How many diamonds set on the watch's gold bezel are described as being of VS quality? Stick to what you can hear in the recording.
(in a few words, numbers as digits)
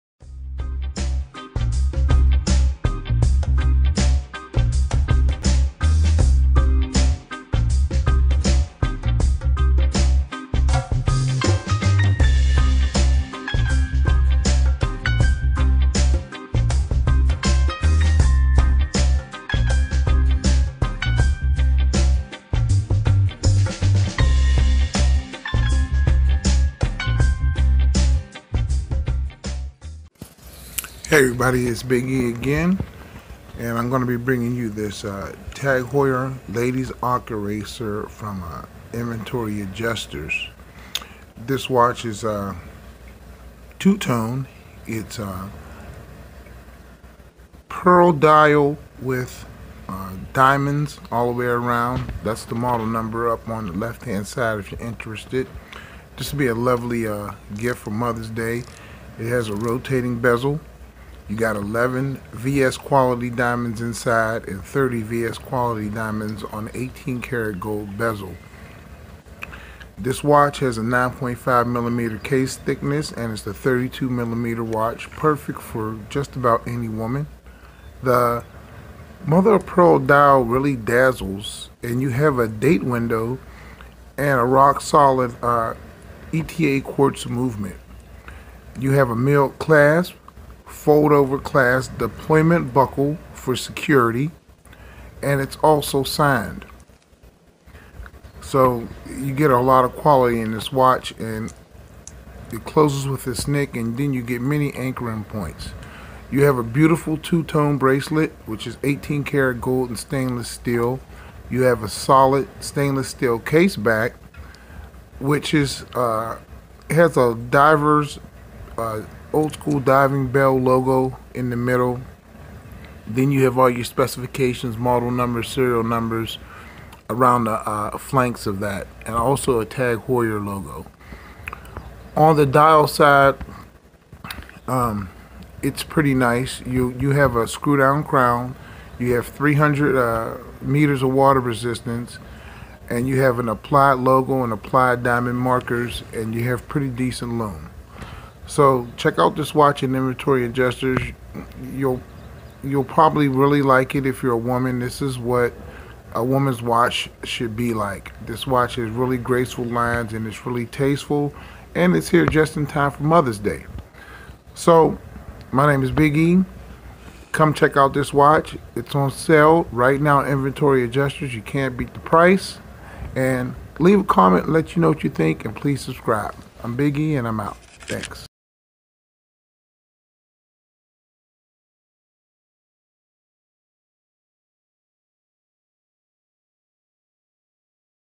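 30.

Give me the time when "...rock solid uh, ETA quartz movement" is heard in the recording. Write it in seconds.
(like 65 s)
84 s.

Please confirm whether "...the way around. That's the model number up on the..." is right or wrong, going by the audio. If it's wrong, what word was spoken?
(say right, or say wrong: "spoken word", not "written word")
right.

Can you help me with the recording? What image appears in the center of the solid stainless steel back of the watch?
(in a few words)
Old school diving bell logo.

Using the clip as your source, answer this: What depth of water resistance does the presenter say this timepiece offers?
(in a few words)
300 meters.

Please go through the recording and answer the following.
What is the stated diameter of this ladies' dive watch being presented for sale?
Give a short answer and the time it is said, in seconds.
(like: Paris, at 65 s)
32 millimeters, at 73 s.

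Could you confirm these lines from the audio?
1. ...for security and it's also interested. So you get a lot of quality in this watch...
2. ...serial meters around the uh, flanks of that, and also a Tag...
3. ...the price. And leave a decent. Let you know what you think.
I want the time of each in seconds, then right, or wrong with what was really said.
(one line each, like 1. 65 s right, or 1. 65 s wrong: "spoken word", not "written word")
1. 93 s wrong: "signed", not "interested"
2. 125 s wrong: "numbers", not "meters"
3. 171 s wrong: "comment", not "decent".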